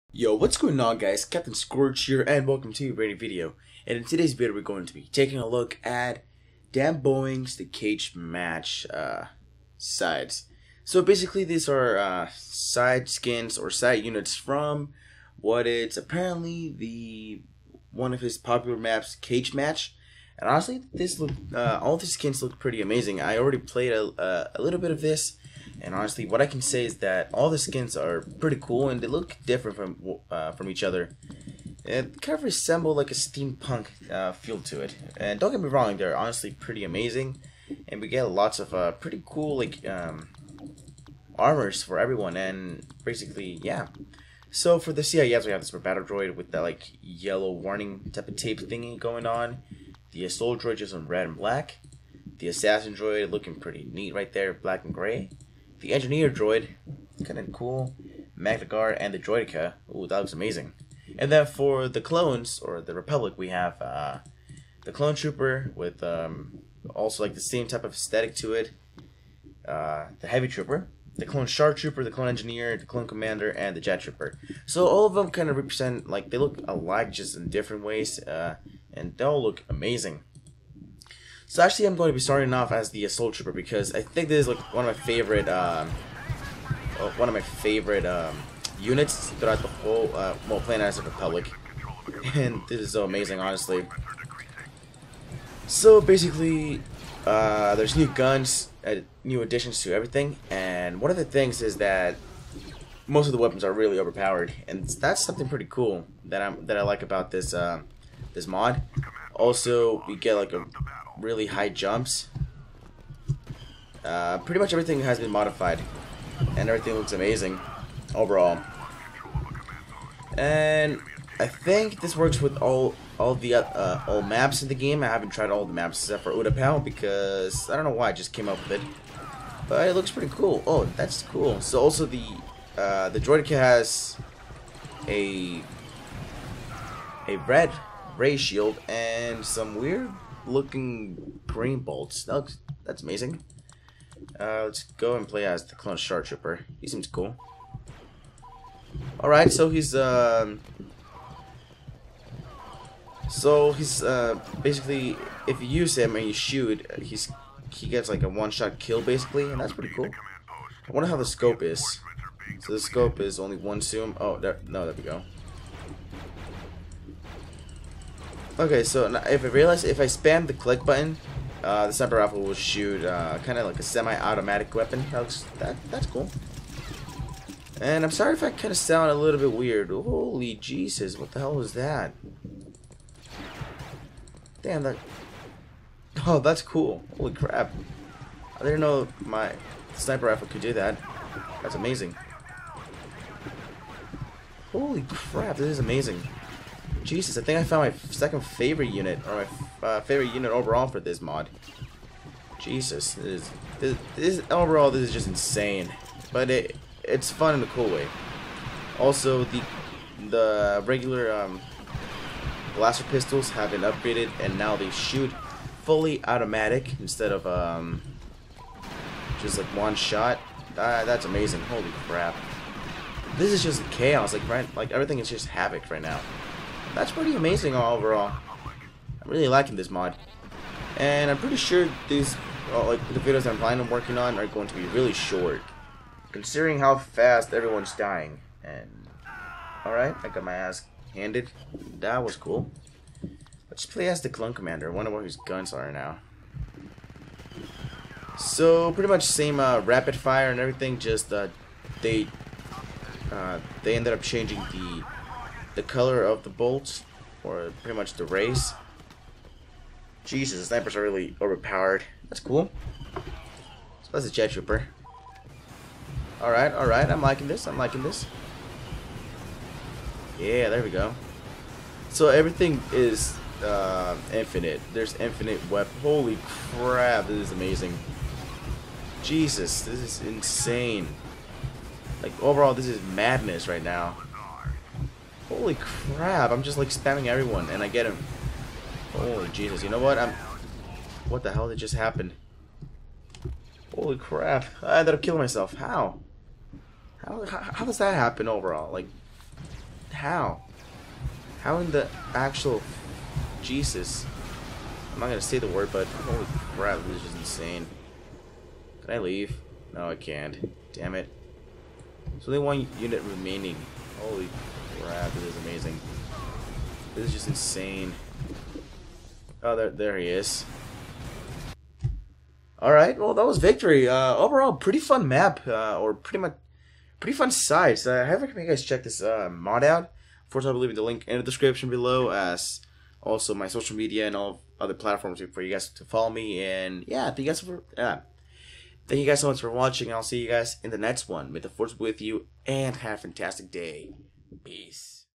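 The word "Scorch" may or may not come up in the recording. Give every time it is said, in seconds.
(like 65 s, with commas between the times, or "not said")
1 s.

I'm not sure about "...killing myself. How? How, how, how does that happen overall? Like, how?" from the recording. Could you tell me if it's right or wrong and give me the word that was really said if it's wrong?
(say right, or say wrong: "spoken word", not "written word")
right.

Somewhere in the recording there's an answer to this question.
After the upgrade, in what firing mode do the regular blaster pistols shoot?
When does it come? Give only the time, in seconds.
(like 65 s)
215 s.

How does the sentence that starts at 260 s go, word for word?
Jesus, the snipers are really overpowered.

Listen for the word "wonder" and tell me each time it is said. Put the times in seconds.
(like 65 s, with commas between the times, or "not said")
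160 s, 244 s.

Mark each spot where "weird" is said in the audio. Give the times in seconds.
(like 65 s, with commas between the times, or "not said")
139 s, 179 s.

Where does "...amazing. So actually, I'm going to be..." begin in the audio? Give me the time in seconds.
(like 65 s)
79 s.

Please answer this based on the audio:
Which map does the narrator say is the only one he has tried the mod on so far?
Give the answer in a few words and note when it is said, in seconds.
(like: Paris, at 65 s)
Utapau, at 126 s.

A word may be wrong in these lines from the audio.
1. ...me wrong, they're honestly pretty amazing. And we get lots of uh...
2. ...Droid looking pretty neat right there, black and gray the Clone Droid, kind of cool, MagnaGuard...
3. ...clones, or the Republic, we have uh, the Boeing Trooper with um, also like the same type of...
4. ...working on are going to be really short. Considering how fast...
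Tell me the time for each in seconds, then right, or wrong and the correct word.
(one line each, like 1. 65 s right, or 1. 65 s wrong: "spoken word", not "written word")
1. 35 s right
2. 52 s wrong: "Engineer", not "Clone"
3. 62 s wrong: "Clone", not "Boeing"
4. 233 s right.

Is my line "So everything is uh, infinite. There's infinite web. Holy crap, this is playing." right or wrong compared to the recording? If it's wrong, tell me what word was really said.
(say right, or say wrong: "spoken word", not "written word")
wrong: "amazing", not "playing".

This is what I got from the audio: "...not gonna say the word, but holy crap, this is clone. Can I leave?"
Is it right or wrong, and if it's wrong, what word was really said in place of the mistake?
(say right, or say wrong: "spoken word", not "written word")
wrong: "insane", not "clone".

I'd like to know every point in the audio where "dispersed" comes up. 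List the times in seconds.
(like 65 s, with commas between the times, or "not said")
not said.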